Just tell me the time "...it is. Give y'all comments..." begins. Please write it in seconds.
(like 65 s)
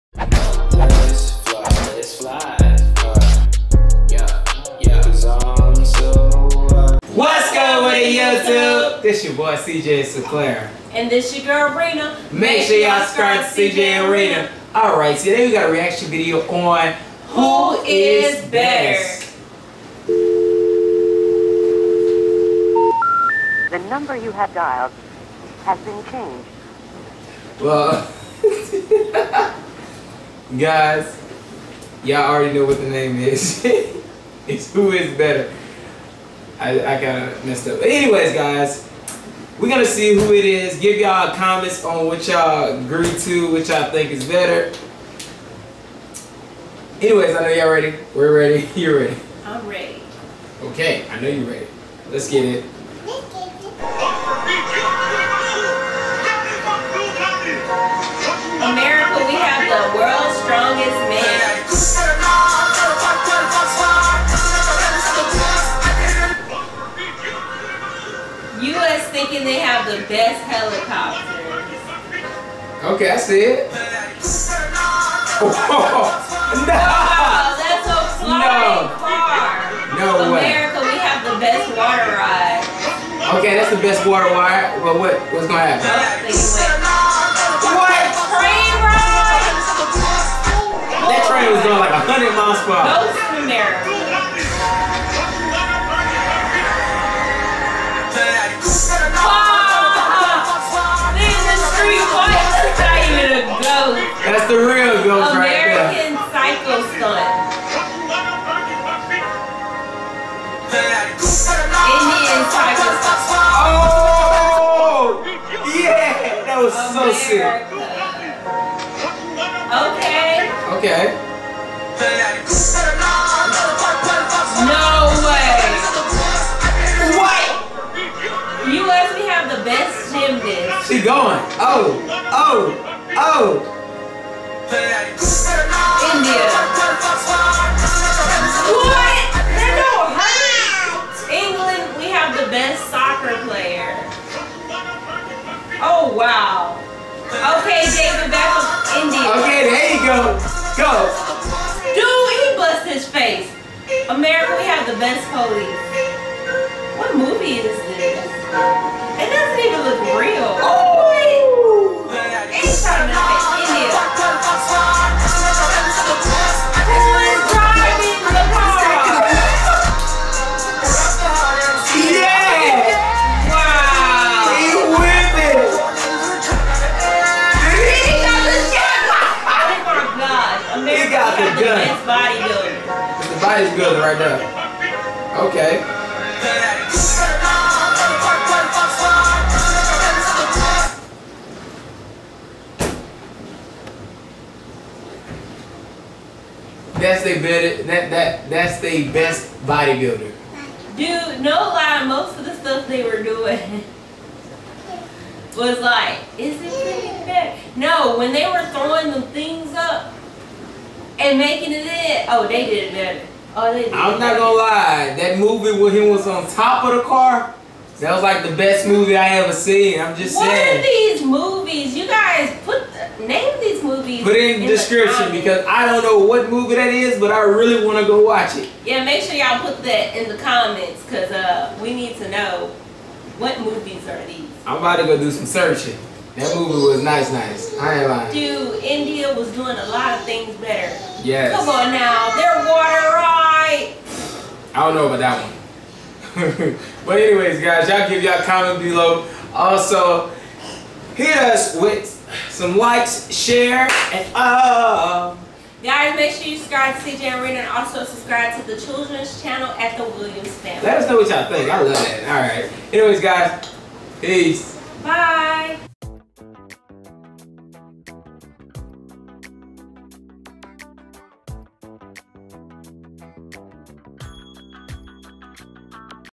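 40 s.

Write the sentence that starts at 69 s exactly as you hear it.
thinking they have the best helicopter.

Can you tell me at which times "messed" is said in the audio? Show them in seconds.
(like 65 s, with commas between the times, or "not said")
37 s.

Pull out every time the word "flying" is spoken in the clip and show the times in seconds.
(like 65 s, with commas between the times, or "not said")
78 s.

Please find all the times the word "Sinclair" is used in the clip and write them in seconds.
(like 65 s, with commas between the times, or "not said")
10 s.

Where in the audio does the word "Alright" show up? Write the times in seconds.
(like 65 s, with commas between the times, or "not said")
14 s, 262 s.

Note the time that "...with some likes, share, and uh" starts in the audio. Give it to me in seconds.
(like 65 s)
251 s.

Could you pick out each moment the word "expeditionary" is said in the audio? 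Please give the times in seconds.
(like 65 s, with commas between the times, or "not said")
not said.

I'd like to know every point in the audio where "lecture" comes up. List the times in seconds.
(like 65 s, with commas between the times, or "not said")
not said.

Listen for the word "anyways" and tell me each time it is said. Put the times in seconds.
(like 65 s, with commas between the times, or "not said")
37 s, 46 s, 247 s, 262 s.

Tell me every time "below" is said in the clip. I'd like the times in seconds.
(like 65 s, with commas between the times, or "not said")
248 s.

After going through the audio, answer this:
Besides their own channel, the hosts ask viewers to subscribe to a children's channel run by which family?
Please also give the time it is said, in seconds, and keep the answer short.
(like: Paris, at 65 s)
The Williams family, at 259 s.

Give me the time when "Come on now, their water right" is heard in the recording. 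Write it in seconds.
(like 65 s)
241 s.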